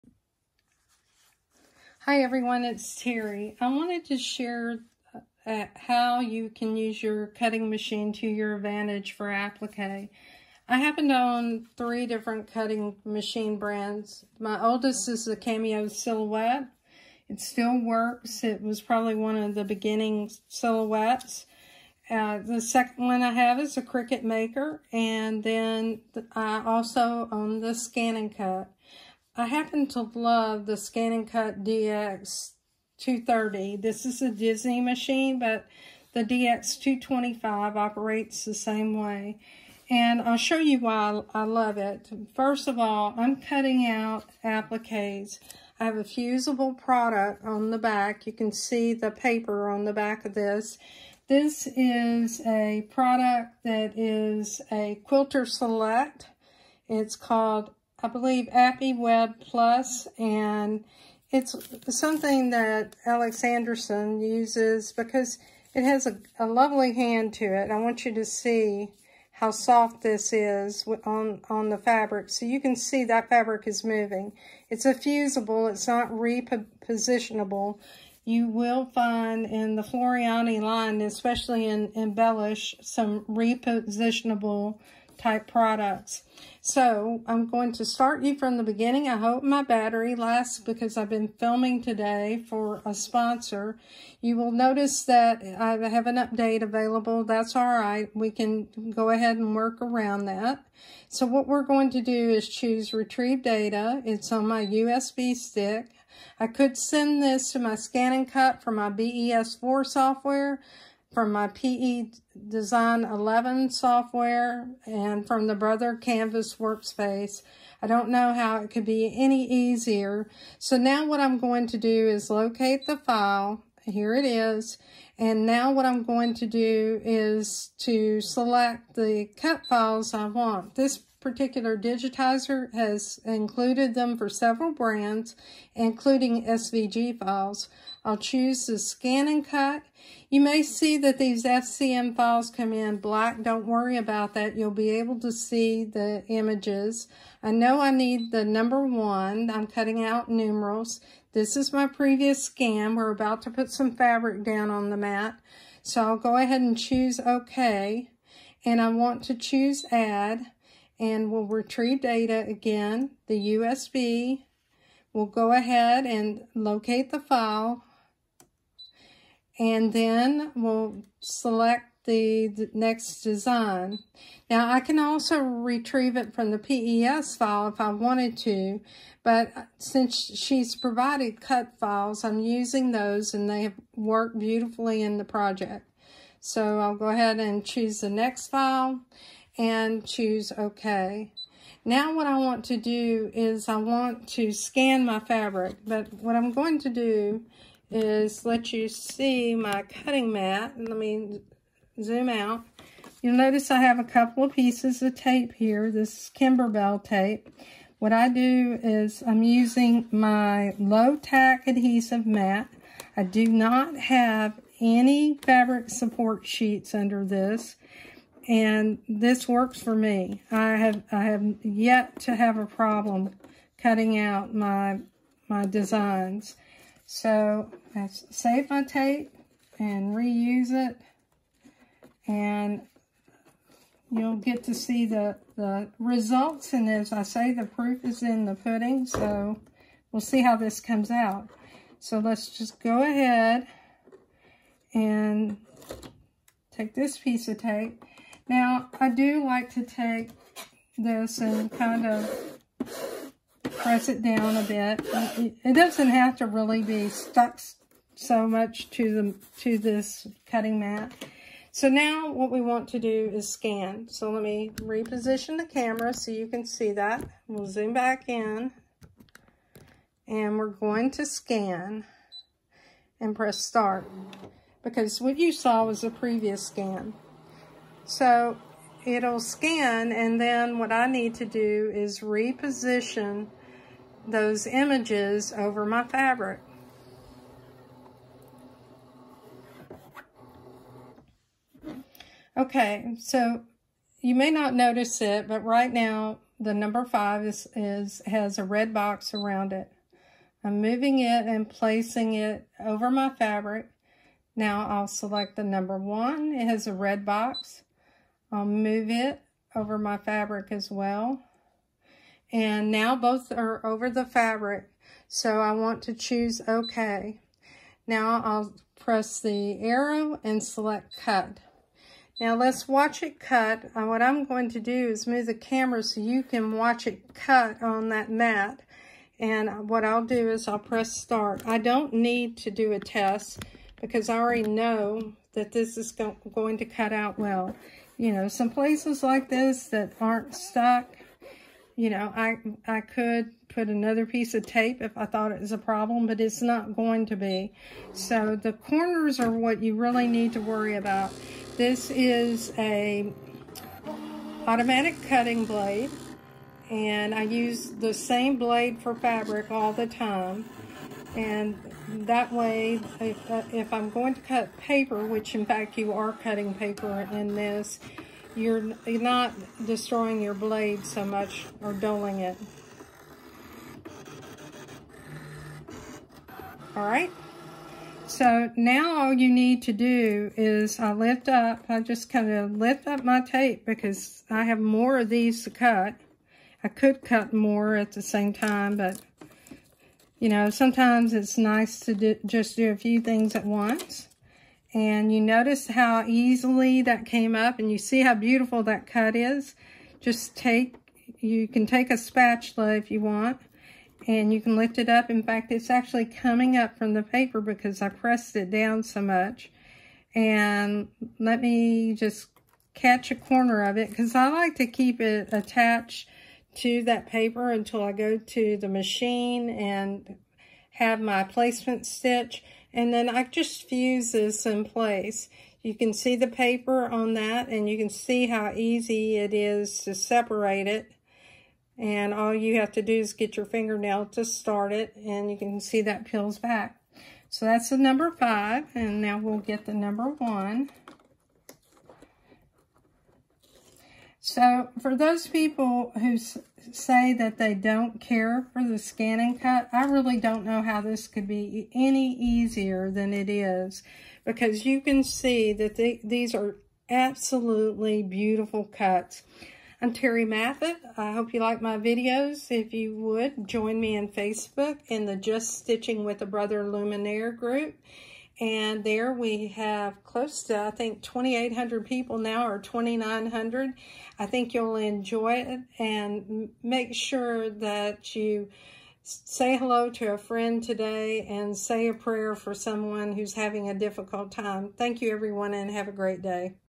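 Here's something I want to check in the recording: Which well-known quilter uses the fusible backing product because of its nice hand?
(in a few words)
Alex Anderson.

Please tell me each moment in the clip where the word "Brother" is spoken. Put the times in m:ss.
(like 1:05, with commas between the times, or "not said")
1:55, 7:46.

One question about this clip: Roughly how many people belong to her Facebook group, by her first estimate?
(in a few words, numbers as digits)
2,800.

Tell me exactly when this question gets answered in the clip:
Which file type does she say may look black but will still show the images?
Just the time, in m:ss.
2:21.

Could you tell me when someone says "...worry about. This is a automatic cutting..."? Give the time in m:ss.
5:50.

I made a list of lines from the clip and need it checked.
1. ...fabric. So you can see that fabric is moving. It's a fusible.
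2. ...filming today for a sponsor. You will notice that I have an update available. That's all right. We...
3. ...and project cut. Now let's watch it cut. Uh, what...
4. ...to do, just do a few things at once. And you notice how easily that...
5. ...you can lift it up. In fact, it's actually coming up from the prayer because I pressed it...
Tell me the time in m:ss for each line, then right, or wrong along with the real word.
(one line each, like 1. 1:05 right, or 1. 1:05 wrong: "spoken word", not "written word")
1. 1:11 right
2. 1:31 right
3. 5:20 wrong: "select", not "project"
4. 6:31 right
5. 6:44 wrong: "paper", not "prayer".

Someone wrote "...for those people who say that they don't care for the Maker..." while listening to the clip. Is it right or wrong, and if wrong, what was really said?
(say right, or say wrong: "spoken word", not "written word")
wrong: "Scan", not "Maker".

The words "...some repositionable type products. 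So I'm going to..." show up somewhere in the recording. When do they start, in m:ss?
1:22.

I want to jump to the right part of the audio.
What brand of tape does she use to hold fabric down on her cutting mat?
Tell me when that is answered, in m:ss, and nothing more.
3:26.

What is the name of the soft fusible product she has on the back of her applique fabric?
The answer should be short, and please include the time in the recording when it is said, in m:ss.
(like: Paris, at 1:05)
Appy Web Plus, at 0:58.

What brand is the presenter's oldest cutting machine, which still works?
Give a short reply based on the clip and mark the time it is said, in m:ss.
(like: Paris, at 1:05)
Cameo Silhouette, at 0:15.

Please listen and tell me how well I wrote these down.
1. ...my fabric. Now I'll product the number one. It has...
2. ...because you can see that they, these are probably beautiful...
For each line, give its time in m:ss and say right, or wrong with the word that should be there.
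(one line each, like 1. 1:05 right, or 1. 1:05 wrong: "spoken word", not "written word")
1. 5:03 wrong: "select", not "product"
2. 7:34 wrong: "absolutely", not "probably".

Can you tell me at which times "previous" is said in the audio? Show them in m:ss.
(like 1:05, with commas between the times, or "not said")
2:31, 4:36.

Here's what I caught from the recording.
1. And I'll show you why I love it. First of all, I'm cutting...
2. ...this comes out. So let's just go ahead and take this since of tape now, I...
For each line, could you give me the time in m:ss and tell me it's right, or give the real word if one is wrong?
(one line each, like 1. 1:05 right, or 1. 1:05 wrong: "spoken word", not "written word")
1. 0:39 right
2. 4:00 wrong: "piece", not "since".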